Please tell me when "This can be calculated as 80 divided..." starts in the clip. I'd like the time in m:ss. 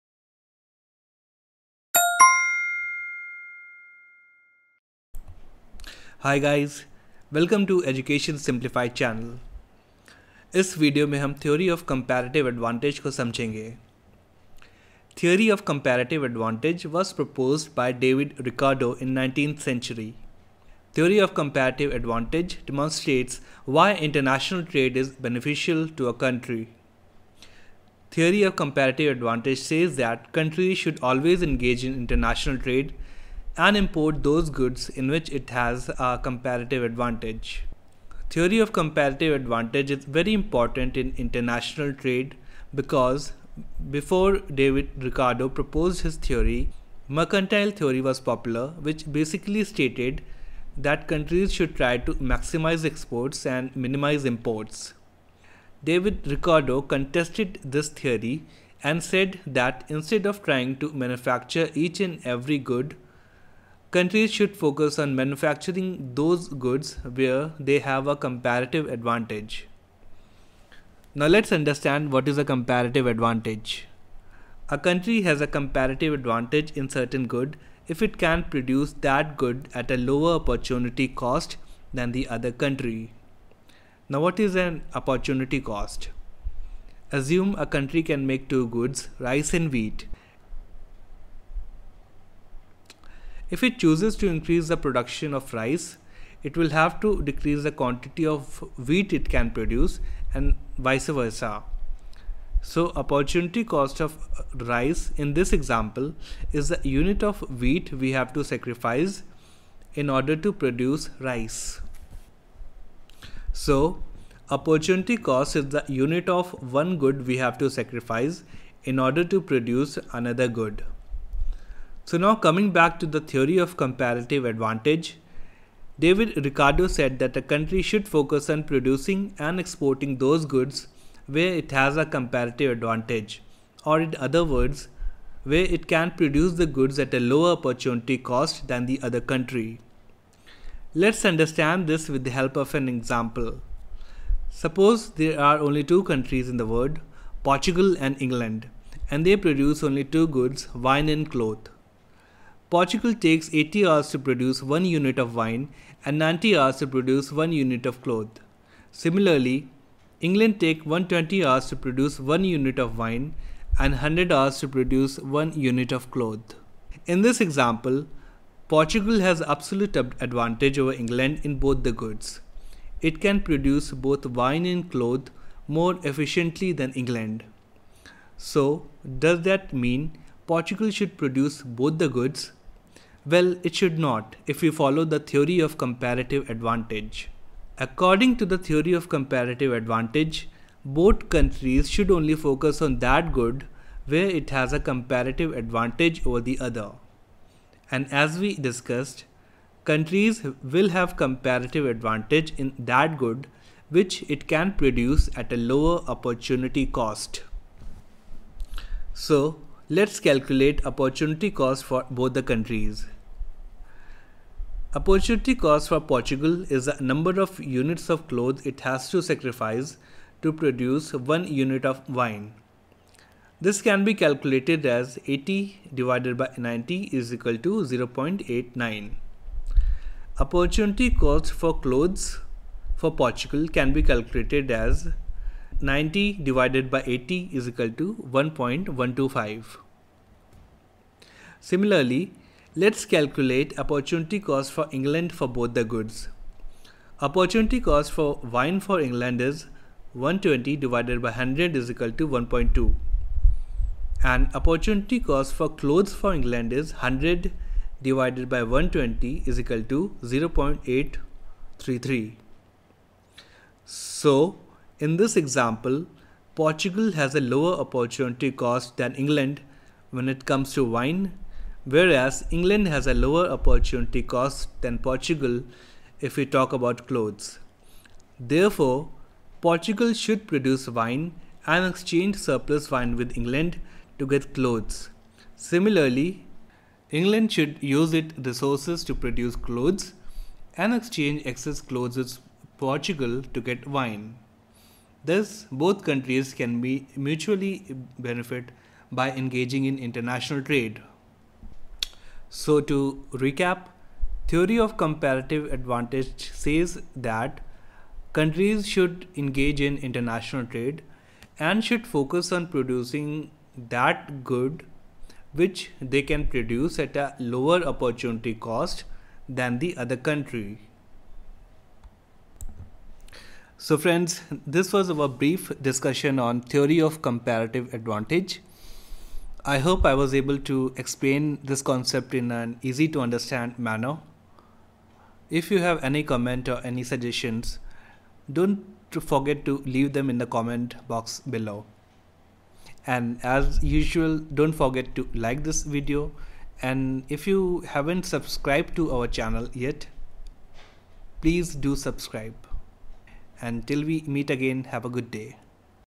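3:43.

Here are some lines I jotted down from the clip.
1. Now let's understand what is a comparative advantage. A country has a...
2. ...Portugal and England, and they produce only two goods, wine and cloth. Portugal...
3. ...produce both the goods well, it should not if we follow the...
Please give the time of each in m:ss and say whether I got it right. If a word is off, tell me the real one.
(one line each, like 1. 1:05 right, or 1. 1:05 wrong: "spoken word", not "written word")
1. 1:11 right
2. 2:27 right
3. 3:01 right.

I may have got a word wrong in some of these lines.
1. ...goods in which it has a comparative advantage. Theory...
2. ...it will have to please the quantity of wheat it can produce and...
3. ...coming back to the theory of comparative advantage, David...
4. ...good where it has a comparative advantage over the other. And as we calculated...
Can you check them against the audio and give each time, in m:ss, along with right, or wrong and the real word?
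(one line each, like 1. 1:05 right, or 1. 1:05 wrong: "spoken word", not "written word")
1. 0:34 right
2. 1:36 wrong: "decrease", not "please"
3. 2:02 right
4. 3:13 wrong: "discussed", not "calculated".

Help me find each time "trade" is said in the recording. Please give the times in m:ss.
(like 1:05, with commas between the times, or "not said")
0:41, 5:00, 5:10.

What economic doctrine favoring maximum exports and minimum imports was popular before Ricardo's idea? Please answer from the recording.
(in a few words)
Mercantile theory.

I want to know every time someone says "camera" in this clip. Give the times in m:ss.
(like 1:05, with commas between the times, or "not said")
not said.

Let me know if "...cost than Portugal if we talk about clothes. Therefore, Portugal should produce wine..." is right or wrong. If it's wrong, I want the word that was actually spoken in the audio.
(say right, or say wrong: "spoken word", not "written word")
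right.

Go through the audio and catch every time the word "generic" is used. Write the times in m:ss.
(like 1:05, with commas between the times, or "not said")
not said.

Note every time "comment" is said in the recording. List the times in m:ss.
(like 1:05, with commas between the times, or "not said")
5:36, 5:40.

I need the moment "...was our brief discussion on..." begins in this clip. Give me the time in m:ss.
5:24.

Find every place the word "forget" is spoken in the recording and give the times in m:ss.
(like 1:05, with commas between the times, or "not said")
5:39, 5:44.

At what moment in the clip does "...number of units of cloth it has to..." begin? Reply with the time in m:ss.
3:37.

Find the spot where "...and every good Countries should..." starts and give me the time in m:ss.
1:01.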